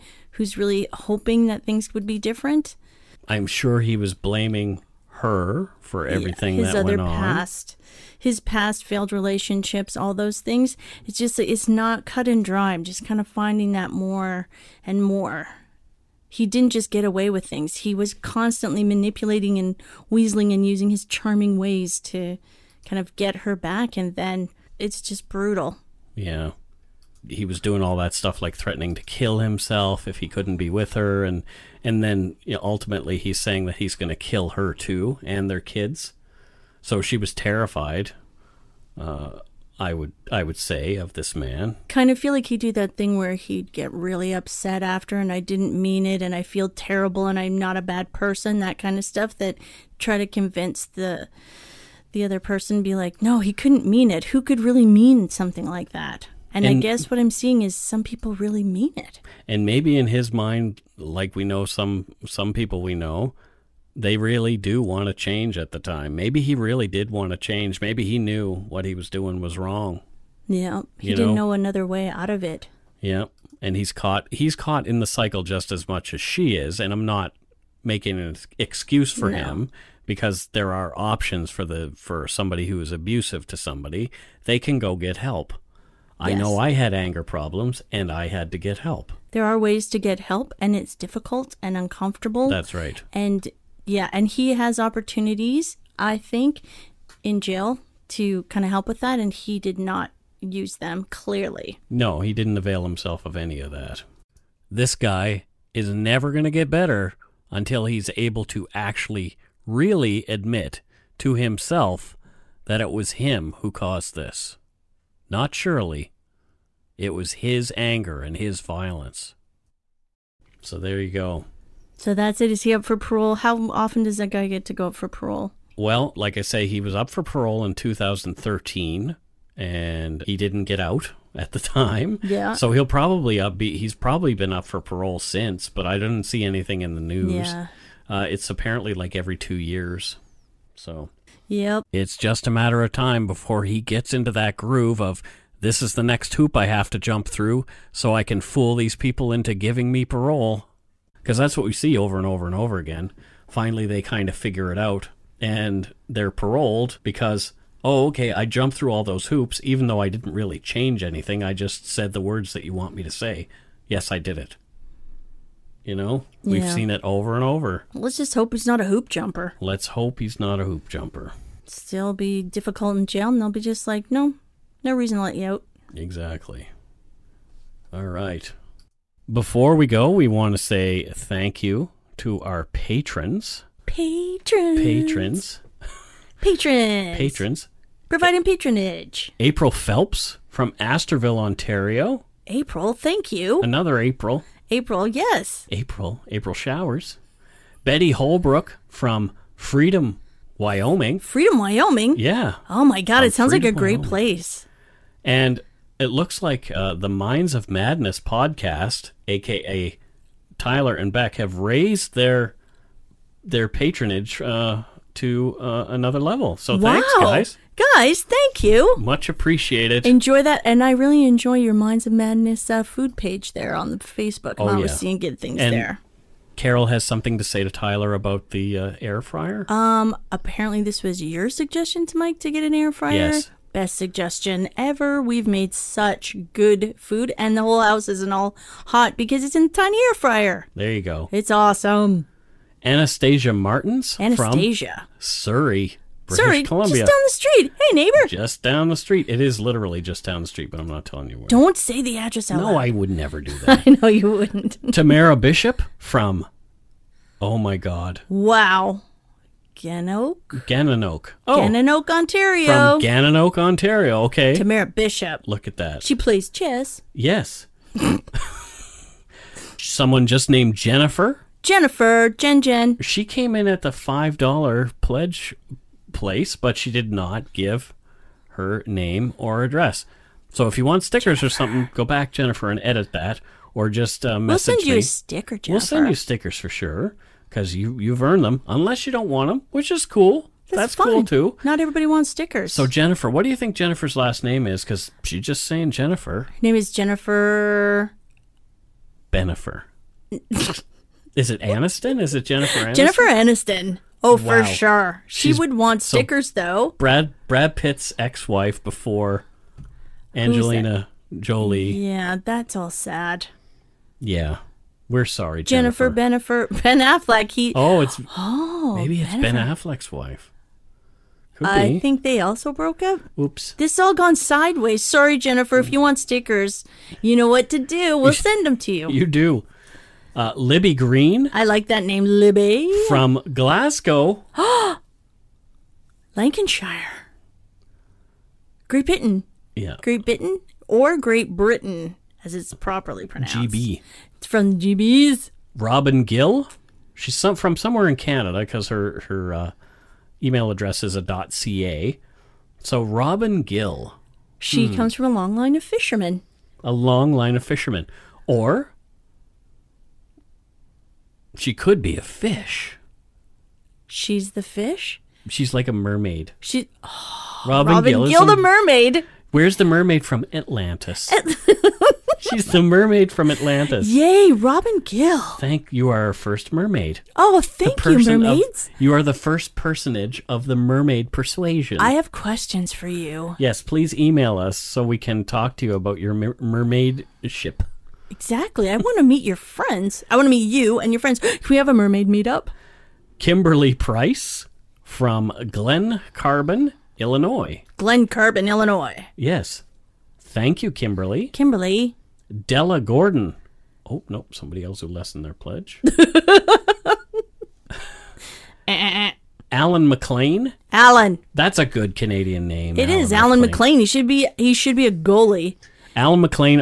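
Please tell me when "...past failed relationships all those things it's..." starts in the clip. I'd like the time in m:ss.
0:08.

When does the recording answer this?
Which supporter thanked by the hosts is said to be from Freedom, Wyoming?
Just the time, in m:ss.
3:17.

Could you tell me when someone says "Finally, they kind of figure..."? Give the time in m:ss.
2:33.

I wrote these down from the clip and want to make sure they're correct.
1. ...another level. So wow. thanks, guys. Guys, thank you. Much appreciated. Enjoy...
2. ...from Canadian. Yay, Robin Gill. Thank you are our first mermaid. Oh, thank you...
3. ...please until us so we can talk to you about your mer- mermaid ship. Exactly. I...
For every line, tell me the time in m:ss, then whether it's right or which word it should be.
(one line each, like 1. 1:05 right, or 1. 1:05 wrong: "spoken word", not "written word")
1. 3:35 right
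2. 6:13 wrong: "Atlantis", not "Canadian"
3. 6:23 wrong: "email", not "until".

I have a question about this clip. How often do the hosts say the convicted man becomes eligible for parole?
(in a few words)
every two years.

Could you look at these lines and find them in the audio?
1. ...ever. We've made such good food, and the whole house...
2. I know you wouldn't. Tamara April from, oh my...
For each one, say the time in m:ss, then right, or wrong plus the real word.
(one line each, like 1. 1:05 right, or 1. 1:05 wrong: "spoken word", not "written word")
1. 3:54 right
2. 4:13 wrong: "Bishop", not "April".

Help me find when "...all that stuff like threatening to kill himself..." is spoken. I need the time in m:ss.
0:27.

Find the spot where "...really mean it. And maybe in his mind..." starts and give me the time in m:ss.
0:58.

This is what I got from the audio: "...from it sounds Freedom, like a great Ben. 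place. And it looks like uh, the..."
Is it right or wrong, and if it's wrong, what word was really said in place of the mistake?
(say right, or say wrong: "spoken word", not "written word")
wrong: "Wyoming", not "Ben".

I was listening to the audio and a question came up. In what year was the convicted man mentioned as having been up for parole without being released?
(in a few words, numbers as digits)
2013.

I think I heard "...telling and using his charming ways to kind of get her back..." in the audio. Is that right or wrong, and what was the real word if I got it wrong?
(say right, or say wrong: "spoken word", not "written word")
wrong: "weaseling", not "telling".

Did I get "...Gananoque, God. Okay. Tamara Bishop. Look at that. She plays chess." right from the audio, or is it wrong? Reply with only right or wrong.
wrong.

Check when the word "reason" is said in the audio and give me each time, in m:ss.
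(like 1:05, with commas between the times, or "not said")
2:54.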